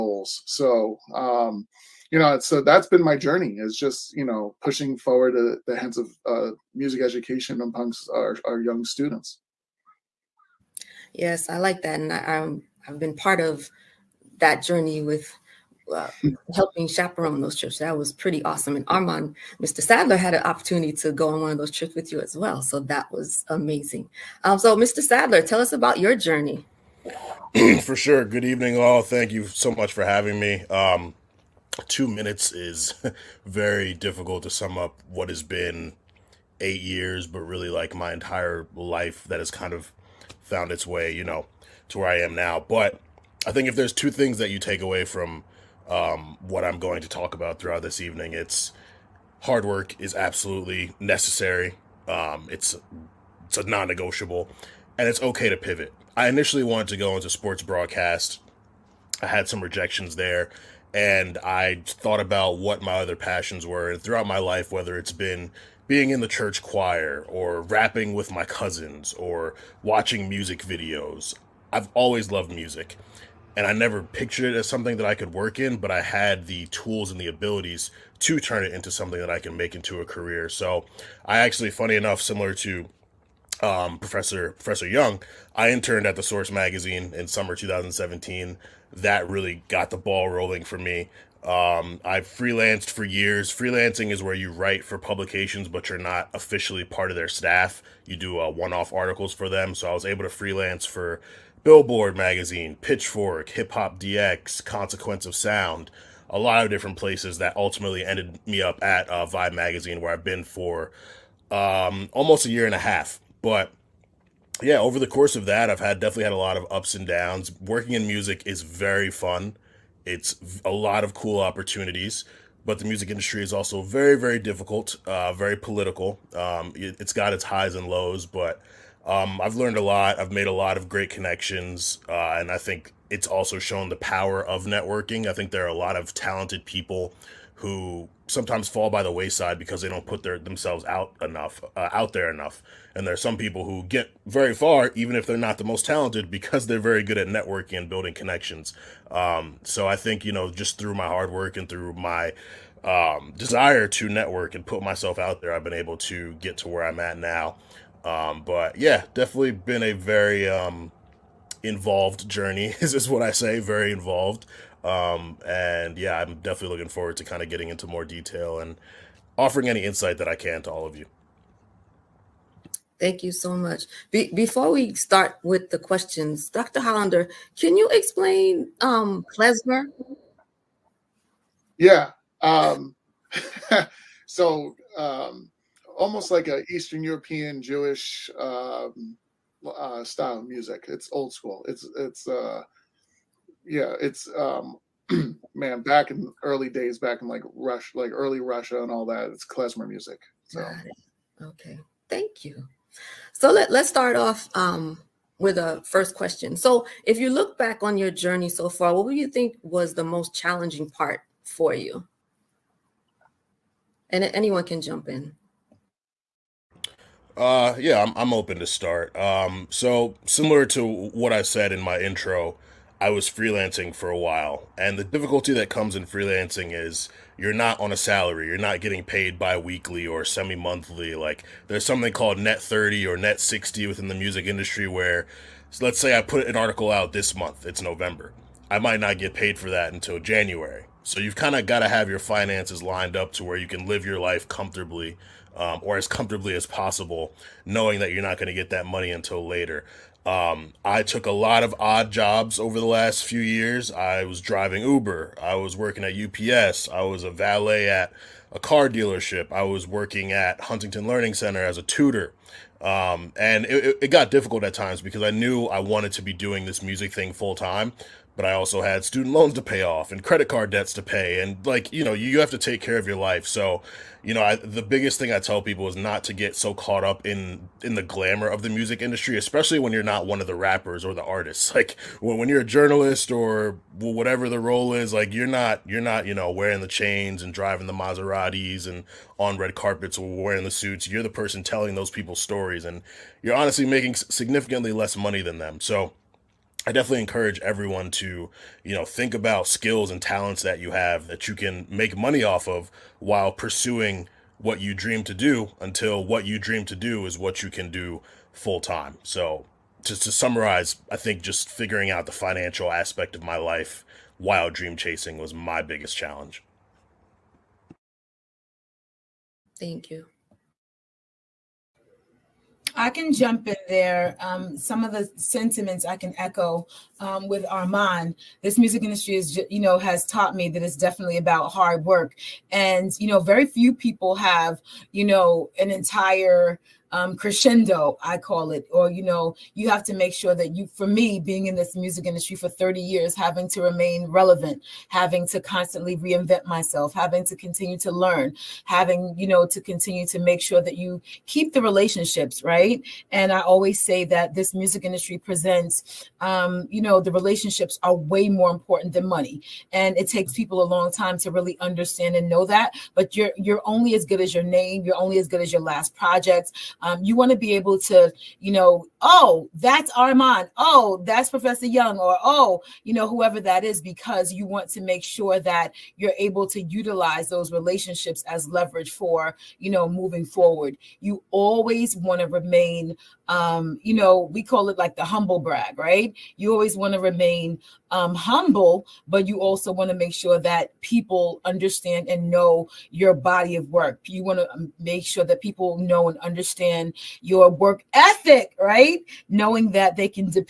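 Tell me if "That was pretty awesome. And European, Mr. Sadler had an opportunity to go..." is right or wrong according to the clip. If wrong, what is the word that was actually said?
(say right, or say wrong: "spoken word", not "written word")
wrong: "Armand", not "European".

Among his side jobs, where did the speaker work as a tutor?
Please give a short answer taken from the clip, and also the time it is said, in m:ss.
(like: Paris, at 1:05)
Huntington Learning Center, at 4:20.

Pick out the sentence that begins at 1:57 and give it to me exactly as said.
Working in music is very fun.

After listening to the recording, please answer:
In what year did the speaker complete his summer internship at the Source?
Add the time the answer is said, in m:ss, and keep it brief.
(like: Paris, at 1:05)
2017, at 1:27.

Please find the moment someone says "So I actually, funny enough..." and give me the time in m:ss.
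1:20.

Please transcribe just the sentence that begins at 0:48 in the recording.
It's hard work is absolutely necessary.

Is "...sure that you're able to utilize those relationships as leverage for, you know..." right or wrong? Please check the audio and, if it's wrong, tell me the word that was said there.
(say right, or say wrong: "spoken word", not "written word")
right.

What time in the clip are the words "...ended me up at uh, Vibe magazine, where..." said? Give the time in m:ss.
1:48.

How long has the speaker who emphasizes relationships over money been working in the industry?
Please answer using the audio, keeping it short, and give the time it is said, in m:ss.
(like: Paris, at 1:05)
30 years, at 5:42.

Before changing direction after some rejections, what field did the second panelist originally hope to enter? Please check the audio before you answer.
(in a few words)
Sports broadcast.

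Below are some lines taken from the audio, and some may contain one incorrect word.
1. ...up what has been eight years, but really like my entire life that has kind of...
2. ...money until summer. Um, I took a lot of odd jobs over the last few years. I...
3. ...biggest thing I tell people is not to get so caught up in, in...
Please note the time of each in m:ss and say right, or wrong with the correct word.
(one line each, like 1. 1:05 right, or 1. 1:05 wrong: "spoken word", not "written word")
1. 0:34 right
2. 4:08 wrong: "later", not "summer"
3. 4:34 right.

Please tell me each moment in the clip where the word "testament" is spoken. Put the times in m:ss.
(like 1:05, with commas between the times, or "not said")
not said.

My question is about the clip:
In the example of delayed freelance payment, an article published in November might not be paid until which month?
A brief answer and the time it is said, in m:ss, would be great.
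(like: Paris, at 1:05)
January, at 4:00.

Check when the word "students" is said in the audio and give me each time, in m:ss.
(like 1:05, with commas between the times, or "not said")
0:08, 4:29.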